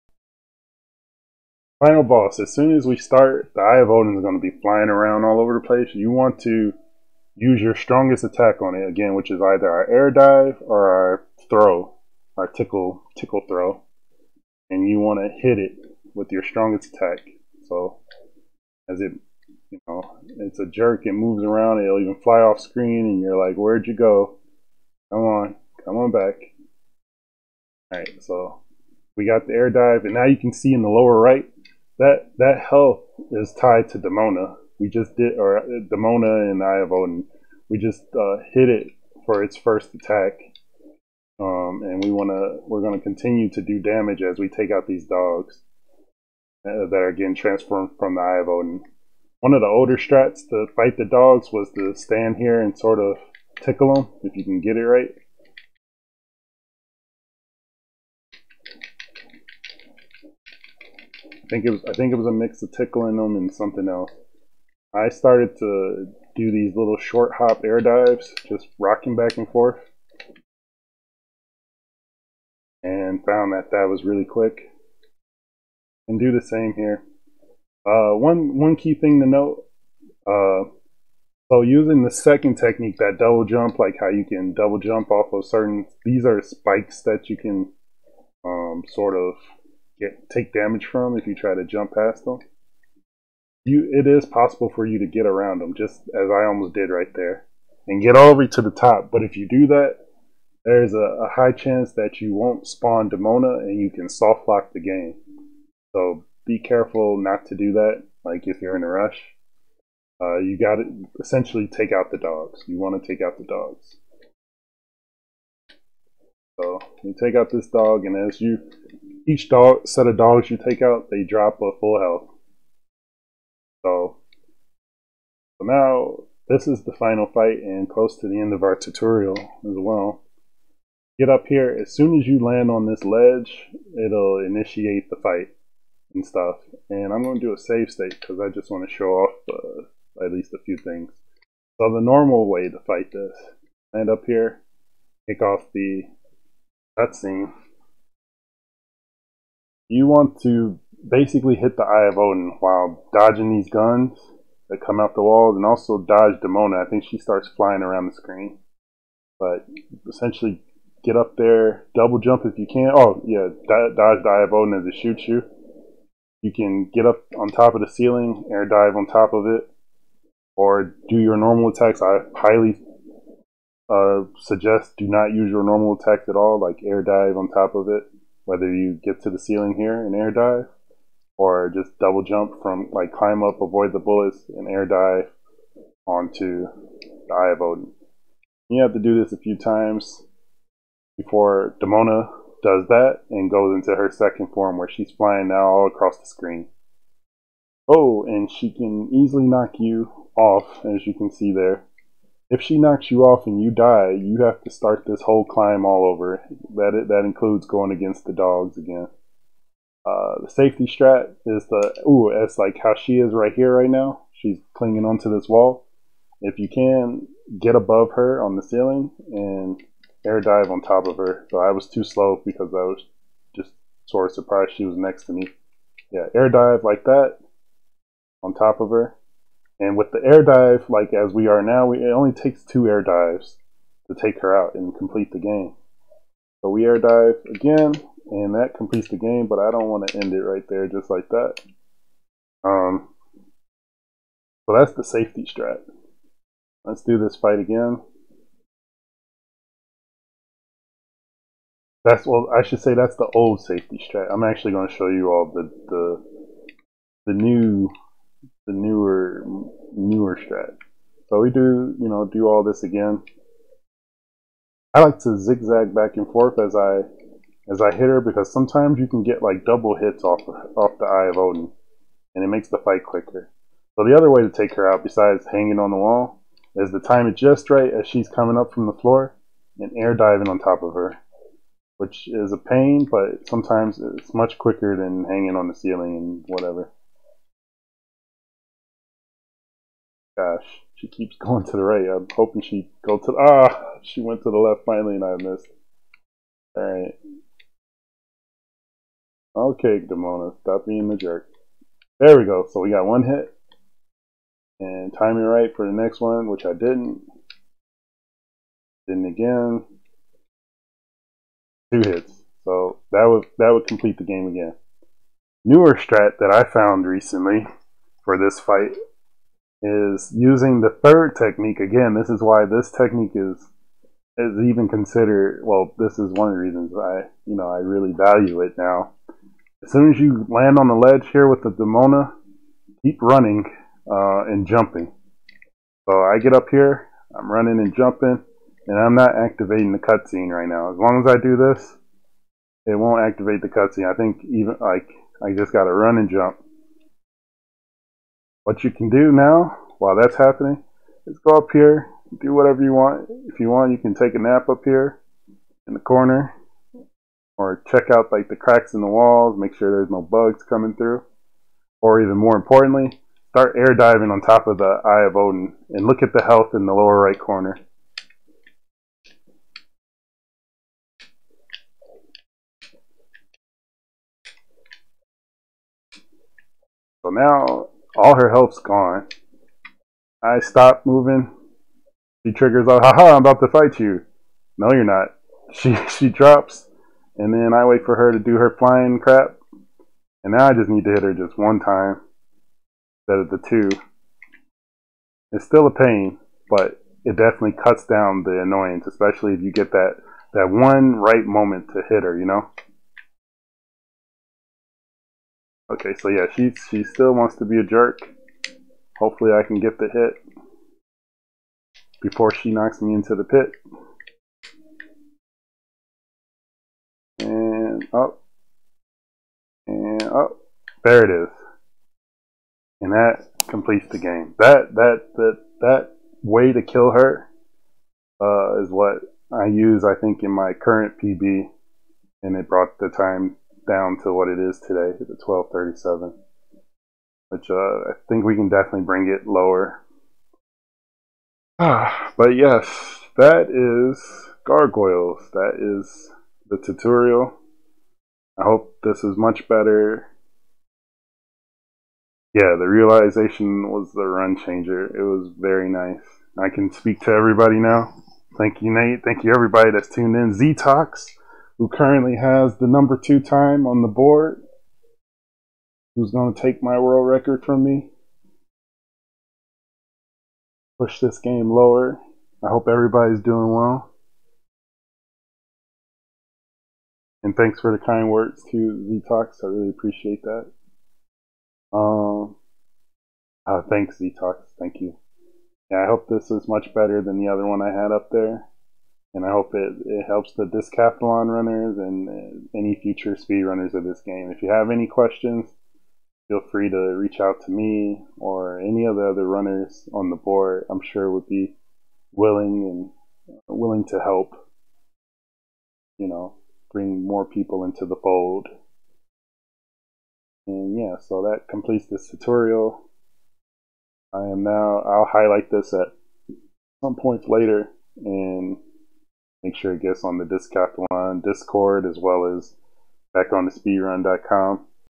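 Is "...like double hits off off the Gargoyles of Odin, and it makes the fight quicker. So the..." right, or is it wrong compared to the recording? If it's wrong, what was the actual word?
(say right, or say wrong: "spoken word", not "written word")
wrong: "Eye", not "Gargoyles".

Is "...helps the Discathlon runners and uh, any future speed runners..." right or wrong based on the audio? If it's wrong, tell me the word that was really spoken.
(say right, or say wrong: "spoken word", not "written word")
right.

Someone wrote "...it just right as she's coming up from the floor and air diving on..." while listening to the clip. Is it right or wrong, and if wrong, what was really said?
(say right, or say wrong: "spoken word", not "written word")
right.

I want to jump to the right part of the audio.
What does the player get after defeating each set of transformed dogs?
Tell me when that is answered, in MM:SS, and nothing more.
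02:01.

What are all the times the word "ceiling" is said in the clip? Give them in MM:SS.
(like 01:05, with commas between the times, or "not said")
02:47, 02:59, 03:38, 04:45.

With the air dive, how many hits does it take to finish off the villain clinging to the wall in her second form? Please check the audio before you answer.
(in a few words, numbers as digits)
2.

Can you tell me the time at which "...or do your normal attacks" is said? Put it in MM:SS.
02:50.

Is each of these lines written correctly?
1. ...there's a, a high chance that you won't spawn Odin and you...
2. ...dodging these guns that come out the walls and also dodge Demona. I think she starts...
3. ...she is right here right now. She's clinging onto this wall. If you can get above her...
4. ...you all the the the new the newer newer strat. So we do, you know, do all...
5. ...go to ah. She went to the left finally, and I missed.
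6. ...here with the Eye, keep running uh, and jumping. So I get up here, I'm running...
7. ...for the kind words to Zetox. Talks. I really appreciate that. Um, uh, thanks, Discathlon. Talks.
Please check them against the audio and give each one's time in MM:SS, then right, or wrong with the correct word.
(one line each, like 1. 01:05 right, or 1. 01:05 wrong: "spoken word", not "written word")
1. 01:40 wrong: "Demona", not "Odin"
2. 02:33 right
3. 03:32 right
4. 04:15 right
5. 04:53 right
6. 05:31 wrong: "Demona", not "Eye"
7. 07:57 wrong: "Zetox", not "Discathlon".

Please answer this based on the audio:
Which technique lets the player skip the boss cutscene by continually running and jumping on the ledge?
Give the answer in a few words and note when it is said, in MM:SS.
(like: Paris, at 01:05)
The third technique, at 05:21.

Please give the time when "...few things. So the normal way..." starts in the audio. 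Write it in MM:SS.
02:20.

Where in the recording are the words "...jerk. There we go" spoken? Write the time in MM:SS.
05:01.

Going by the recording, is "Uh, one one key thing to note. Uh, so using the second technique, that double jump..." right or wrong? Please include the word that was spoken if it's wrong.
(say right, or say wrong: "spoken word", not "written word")
right.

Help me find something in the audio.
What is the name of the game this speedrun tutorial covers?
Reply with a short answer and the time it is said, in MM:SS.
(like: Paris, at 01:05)
Gargoyles, at 07:24.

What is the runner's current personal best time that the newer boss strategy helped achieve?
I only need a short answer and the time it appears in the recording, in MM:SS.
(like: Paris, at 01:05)
12:37, at 07:15.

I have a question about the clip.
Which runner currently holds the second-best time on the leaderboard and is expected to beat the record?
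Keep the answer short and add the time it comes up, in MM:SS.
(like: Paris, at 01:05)
Z Talks, at 07:40.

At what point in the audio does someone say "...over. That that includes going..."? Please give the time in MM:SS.
03:26.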